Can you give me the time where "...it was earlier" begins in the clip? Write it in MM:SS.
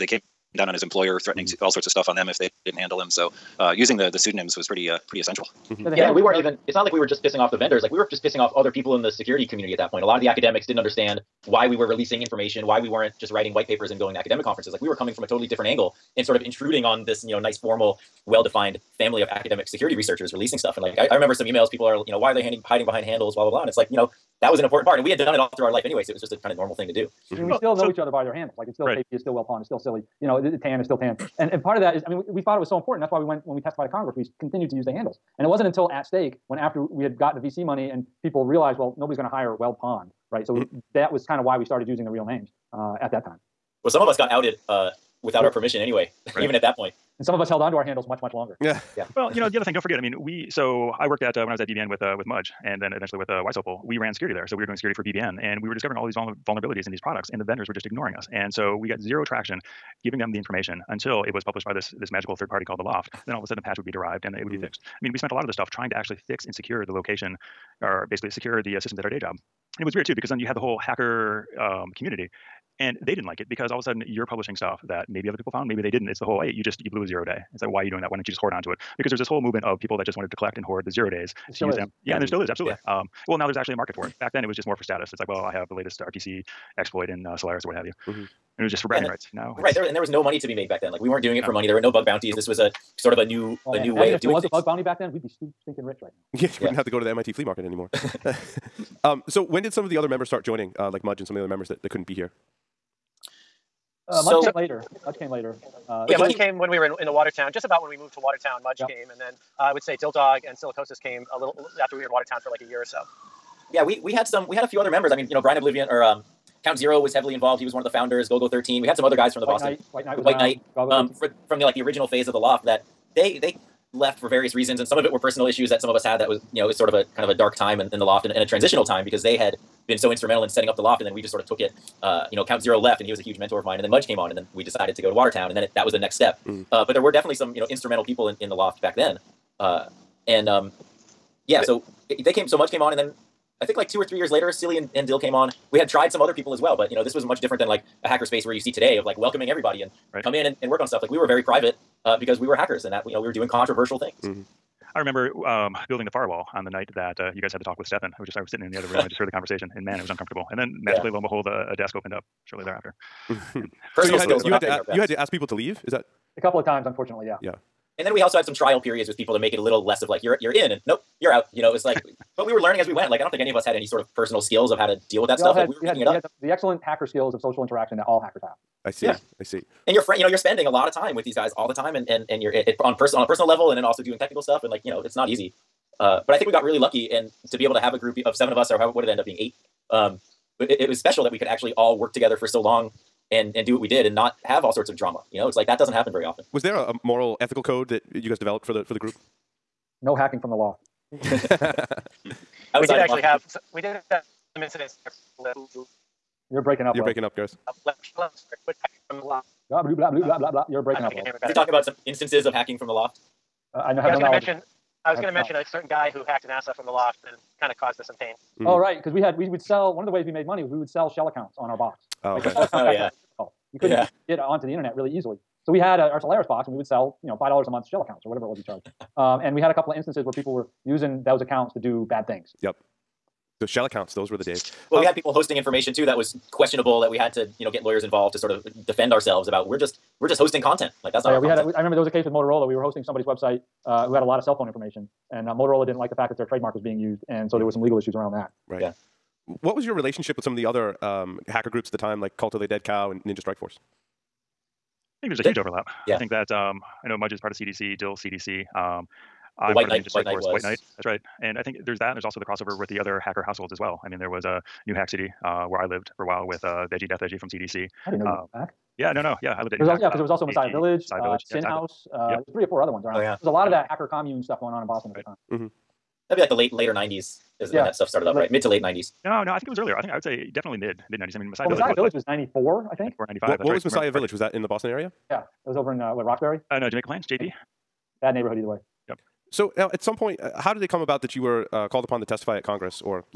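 04:39.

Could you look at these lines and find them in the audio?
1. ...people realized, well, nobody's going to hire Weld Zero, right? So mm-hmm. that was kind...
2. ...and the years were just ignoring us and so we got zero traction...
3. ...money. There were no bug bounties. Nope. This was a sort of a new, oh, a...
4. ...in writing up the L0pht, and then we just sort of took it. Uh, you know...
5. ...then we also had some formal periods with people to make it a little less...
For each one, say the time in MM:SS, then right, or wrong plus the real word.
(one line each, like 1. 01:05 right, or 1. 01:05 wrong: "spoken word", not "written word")
1. 00:38 wrong: "Pond", not "Zero"
2. 00:57 wrong: "vendors", not "years"
3. 01:31 right
4. 02:10 wrong: "setting", not "writing"
5. 02:48 wrong: "trial", not "formal".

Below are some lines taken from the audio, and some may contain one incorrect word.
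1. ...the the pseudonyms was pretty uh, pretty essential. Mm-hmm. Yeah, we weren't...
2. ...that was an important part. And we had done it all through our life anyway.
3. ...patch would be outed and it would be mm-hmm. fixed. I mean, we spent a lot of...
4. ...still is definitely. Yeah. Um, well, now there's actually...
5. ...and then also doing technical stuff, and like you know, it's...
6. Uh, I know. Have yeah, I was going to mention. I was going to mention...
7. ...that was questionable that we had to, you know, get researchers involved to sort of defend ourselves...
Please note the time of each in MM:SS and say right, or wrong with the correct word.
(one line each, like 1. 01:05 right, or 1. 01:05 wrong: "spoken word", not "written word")
1. 00:03 right
2. 00:24 right
3. 01:03 wrong: "derived", not "outed"
4. 01:22 wrong: "absolutely", not "definitely"
5. 03:03 right
6. 03:33 right
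7. 03:56 wrong: "lawyers", not "researchers".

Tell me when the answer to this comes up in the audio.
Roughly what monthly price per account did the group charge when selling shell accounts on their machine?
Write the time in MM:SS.
03:47.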